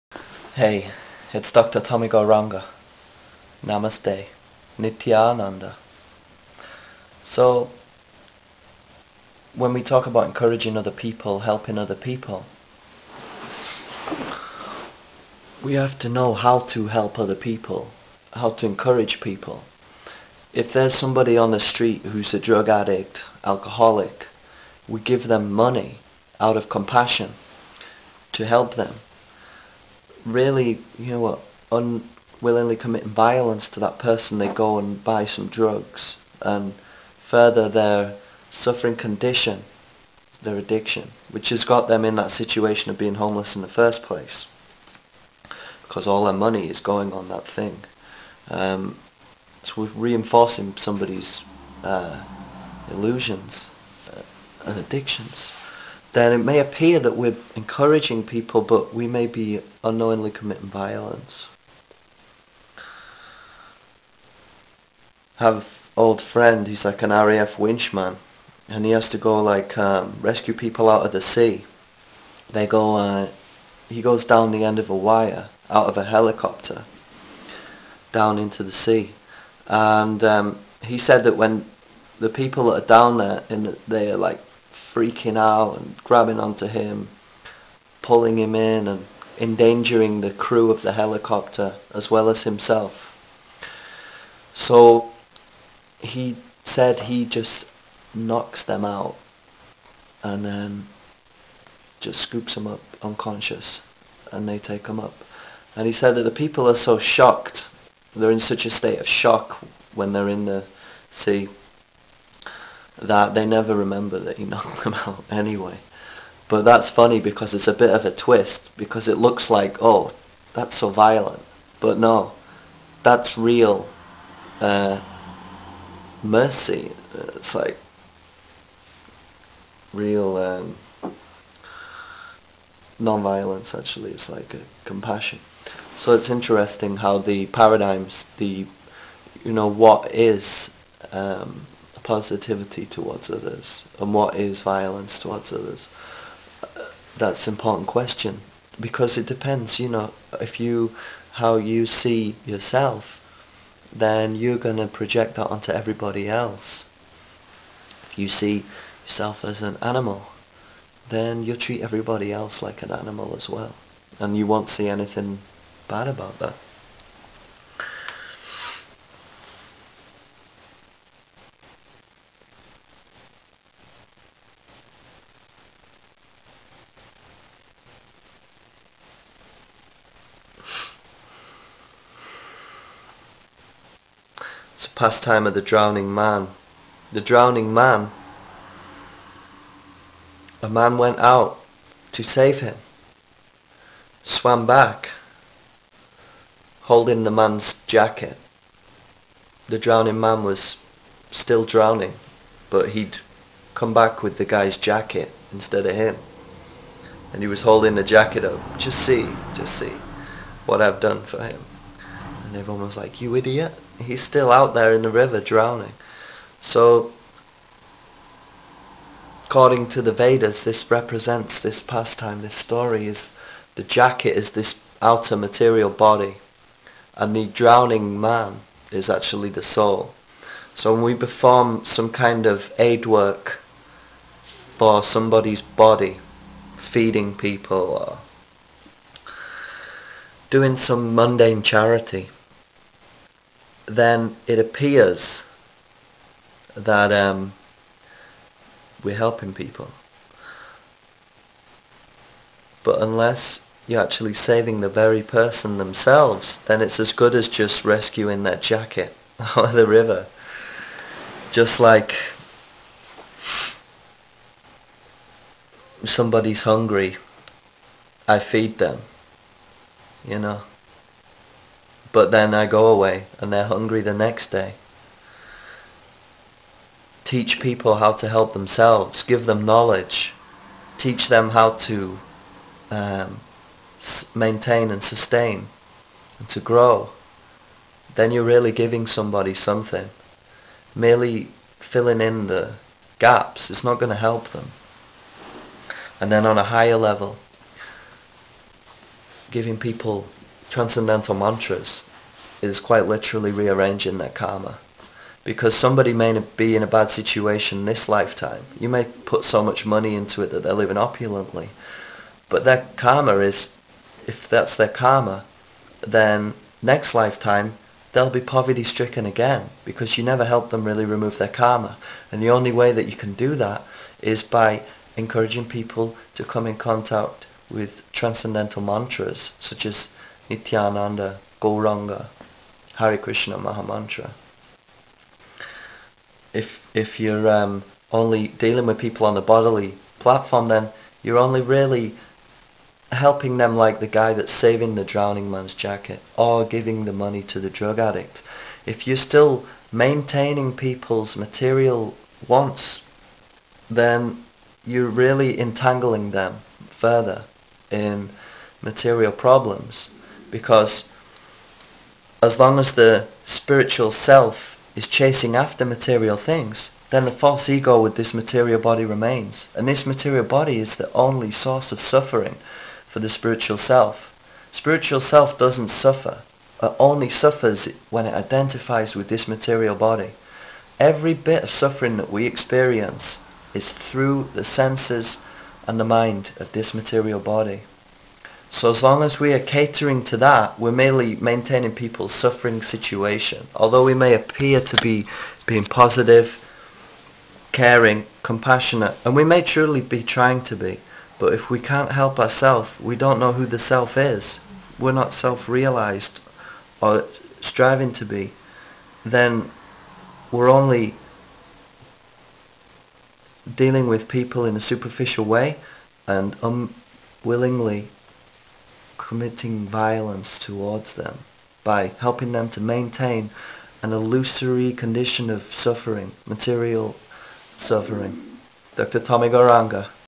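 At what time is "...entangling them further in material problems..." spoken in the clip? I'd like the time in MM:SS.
05:55.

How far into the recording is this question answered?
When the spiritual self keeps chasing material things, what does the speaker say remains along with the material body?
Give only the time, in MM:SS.
06:07.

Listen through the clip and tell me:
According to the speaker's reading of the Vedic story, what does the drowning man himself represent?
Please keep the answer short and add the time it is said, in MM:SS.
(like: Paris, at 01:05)
The soul, at 03:49.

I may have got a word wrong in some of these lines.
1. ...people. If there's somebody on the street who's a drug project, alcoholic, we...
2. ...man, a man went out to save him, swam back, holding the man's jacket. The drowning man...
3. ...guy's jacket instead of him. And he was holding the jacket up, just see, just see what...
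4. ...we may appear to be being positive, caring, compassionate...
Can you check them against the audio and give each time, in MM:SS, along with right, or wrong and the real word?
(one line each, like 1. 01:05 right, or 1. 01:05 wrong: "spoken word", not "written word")
1. 00:19 wrong: "addict", not "project"
2. 03:07 right
3. 03:24 right
4. 06:34 right.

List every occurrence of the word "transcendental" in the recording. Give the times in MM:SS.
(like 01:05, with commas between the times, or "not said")
05:00, 05:28.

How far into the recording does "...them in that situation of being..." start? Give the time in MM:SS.
00:41.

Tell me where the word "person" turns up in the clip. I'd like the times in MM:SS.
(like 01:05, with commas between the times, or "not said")
00:33, 04:15.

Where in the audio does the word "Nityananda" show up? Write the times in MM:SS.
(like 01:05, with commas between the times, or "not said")
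00:04, 05:30.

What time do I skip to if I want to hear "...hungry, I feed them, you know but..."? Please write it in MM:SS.
04:26.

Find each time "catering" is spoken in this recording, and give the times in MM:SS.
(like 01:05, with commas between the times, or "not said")
06:29.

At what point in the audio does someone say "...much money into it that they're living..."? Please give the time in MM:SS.
05:09.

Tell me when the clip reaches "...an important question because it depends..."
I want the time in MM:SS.
02:27.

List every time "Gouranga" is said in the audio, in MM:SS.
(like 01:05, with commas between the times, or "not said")
00:02, 07:09.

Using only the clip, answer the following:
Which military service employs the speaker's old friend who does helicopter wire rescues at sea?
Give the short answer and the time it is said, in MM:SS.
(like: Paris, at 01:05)
RAF, at 01:07.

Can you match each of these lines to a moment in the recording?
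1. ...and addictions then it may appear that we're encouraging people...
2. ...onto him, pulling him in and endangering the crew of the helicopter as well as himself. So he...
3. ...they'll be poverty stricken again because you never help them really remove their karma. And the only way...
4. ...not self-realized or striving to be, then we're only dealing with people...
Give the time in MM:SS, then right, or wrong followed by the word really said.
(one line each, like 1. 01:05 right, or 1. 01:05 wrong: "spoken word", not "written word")
1. 00:54 right
2. 01:26 right
3. 05:18 right
4. 06:45 right.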